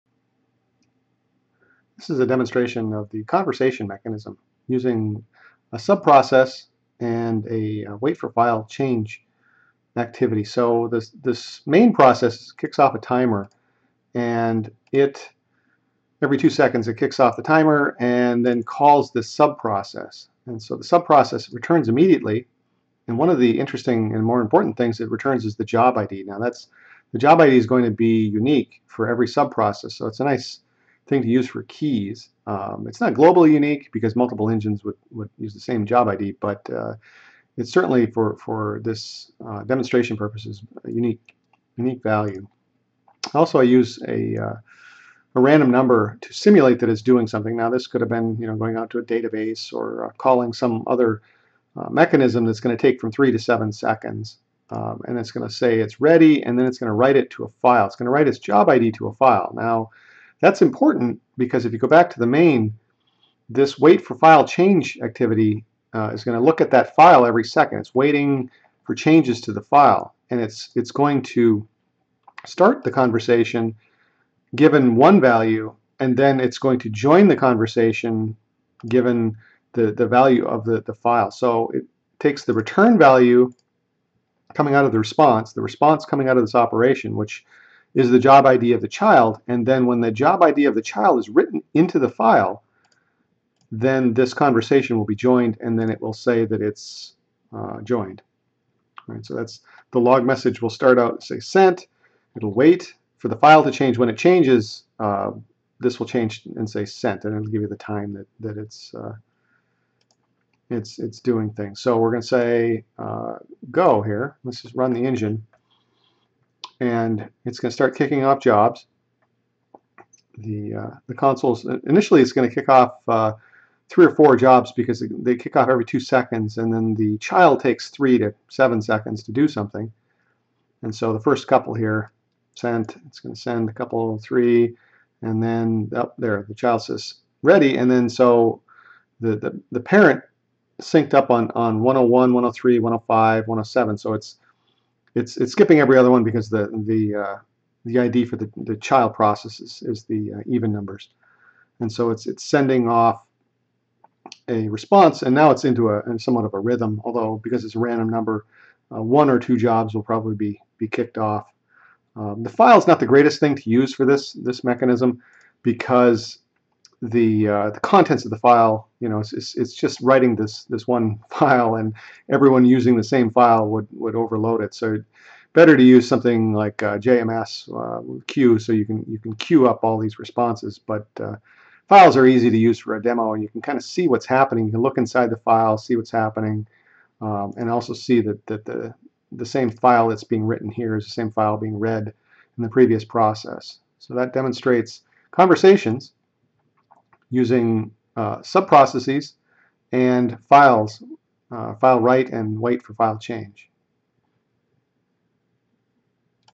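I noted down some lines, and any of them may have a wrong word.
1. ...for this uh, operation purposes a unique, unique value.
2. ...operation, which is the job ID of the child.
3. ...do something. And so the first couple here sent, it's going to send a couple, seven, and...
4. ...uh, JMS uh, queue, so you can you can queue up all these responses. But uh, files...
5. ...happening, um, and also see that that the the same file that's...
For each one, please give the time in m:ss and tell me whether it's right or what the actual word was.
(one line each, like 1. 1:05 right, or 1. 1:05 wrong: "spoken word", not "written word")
1. 0:38 wrong: "demonstration", not "operation"
2. 1:26 right
3. 2:09 wrong: "three", not "seven"
4. 2:56 right
5. 3:06 right.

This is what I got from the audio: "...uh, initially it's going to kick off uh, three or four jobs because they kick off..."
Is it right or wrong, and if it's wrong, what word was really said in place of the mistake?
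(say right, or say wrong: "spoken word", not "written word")
right.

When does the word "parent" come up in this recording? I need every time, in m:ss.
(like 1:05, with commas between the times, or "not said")
2:19.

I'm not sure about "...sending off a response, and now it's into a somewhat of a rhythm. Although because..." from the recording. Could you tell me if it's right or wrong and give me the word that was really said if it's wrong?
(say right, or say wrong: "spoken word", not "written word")
right.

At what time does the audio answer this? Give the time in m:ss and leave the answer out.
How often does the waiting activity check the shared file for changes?
1:07.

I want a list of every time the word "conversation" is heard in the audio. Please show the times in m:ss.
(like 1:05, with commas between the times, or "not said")
0:03, 1:12, 1:17, 1:34, 3:15.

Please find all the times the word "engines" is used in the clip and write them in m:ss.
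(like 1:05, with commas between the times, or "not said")
0:34, 1:55.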